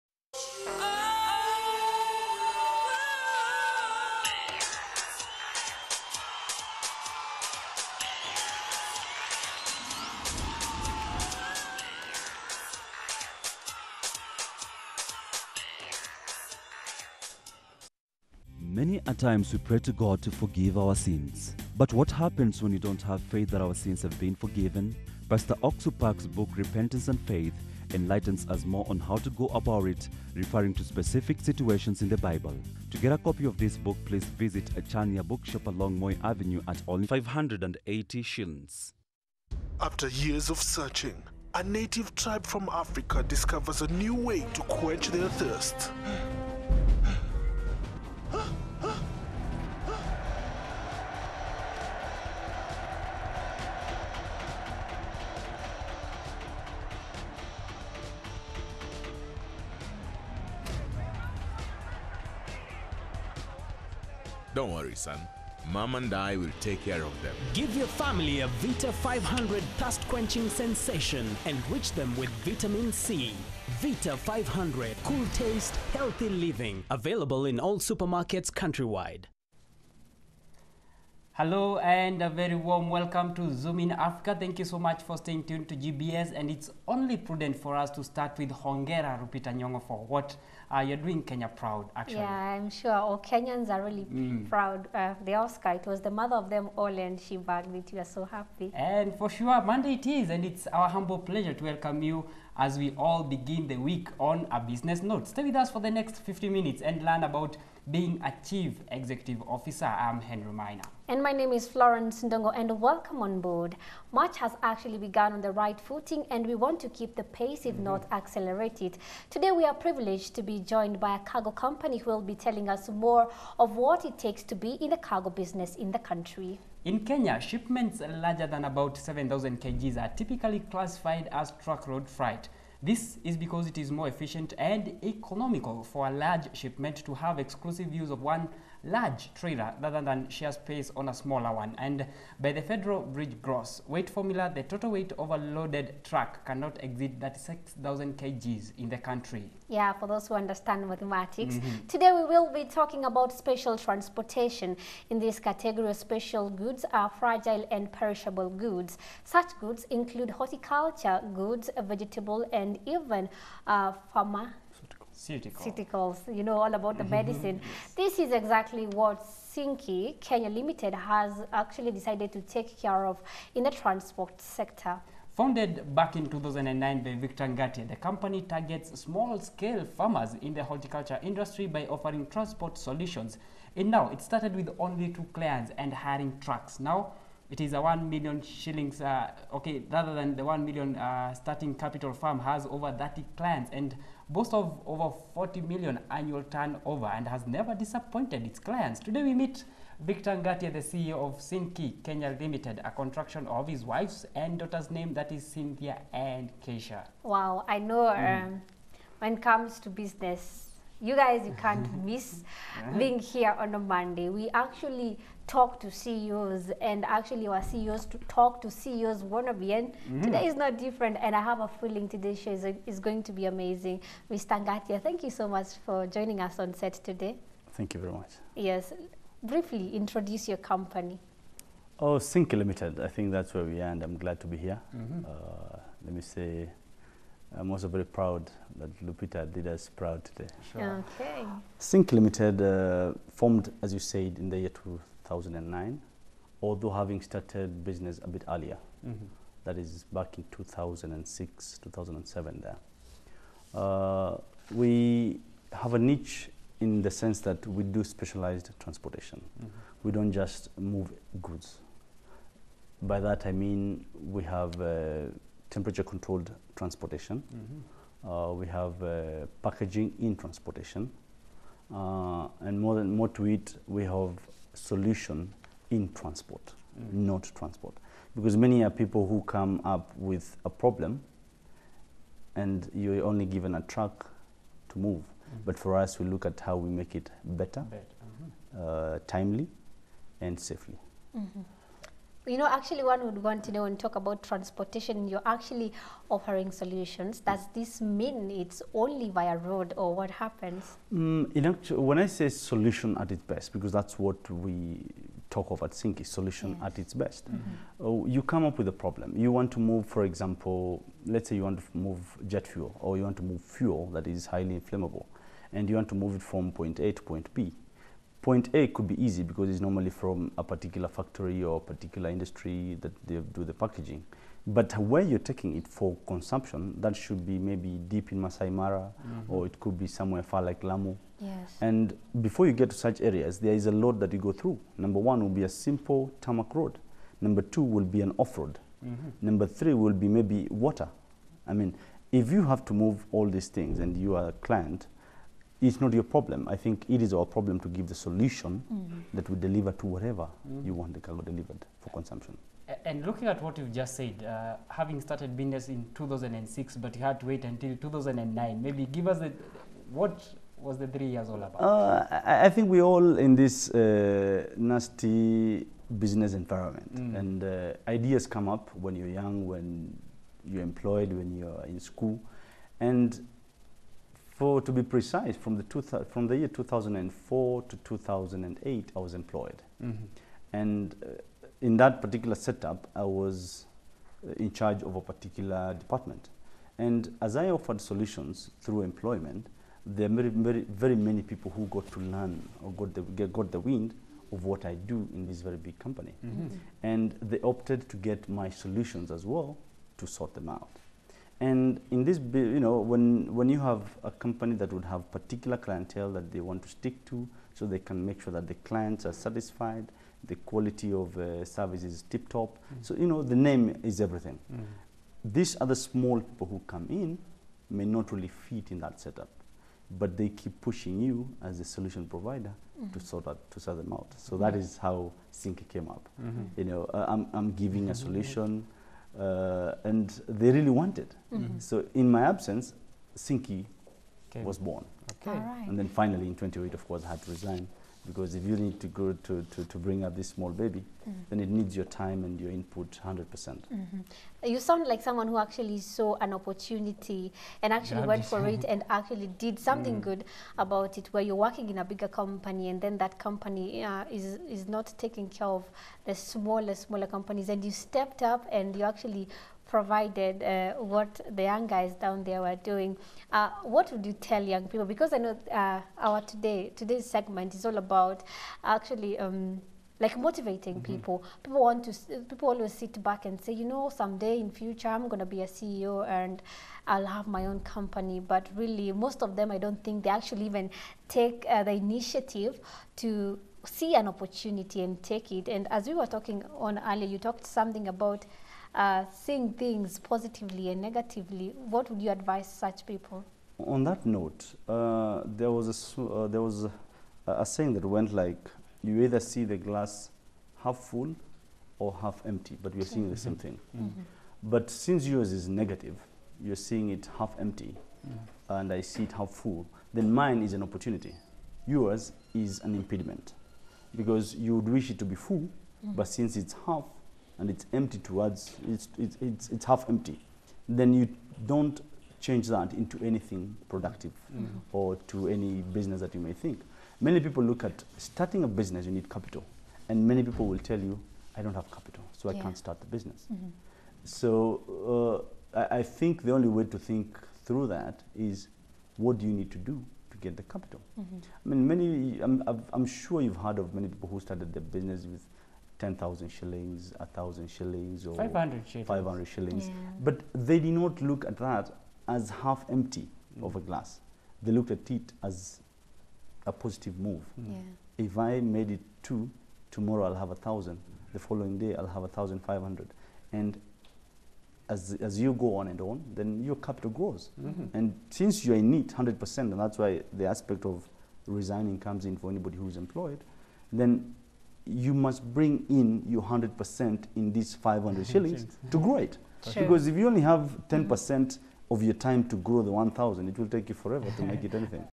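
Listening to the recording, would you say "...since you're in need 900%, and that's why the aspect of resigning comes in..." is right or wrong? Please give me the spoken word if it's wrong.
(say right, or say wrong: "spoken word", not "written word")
wrong: "100", not "900".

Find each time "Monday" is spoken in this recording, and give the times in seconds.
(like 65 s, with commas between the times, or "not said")
99 s, 213 s.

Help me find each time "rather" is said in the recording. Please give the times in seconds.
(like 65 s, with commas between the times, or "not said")
139 s, 189 s.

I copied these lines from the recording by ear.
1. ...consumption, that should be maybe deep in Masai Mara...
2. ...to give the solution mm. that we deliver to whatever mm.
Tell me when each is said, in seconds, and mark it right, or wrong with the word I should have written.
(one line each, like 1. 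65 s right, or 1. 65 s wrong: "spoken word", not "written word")
1. 326 s right
2. 347 s right.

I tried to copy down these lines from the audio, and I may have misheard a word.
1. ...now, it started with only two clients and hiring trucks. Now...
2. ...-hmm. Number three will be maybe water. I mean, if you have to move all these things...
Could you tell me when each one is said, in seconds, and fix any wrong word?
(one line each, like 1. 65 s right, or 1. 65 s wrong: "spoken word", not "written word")
1. 183 s right
2. 339 s right.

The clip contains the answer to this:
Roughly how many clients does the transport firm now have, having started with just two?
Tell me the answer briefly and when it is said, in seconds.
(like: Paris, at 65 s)
over 30, at 192 s.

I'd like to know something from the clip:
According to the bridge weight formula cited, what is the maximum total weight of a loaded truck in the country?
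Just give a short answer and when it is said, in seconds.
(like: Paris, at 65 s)
36,000 kgs, at 147 s.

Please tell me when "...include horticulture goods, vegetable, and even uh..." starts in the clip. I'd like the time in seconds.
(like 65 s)
159 s.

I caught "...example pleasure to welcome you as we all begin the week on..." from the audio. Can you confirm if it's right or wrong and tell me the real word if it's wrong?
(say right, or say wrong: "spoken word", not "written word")
wrong: "humble", not "example".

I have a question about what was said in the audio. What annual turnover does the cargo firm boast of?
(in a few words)
over 40 million.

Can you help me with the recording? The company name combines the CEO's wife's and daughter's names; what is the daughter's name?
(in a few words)
Keisha.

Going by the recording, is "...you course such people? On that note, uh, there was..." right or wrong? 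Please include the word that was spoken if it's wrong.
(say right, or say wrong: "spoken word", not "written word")
wrong: "advise", not "course".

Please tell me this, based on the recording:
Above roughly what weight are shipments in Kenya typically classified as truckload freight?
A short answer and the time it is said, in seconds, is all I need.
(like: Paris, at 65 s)
7,000 kgs, at 128 s.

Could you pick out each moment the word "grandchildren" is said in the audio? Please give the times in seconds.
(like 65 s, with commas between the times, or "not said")
not said.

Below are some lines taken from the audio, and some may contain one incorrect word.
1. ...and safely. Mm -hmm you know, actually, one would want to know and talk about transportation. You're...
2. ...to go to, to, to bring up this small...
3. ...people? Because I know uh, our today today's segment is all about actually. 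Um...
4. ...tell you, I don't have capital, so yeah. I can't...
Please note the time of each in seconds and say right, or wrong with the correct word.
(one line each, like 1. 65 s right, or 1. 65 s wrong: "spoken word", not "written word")
1. 290 s right
2. 438 s right
3. 464 s right
4. 530 s right.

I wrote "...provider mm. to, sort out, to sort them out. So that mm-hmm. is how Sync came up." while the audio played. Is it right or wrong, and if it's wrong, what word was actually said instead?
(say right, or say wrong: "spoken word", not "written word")
right.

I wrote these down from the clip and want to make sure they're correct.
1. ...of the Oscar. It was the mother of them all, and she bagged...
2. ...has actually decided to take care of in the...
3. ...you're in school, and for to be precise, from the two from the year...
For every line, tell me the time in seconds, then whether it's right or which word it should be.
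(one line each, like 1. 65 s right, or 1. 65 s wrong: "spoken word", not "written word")
1. 94 s right
2. 170 s right
3. 371 s right.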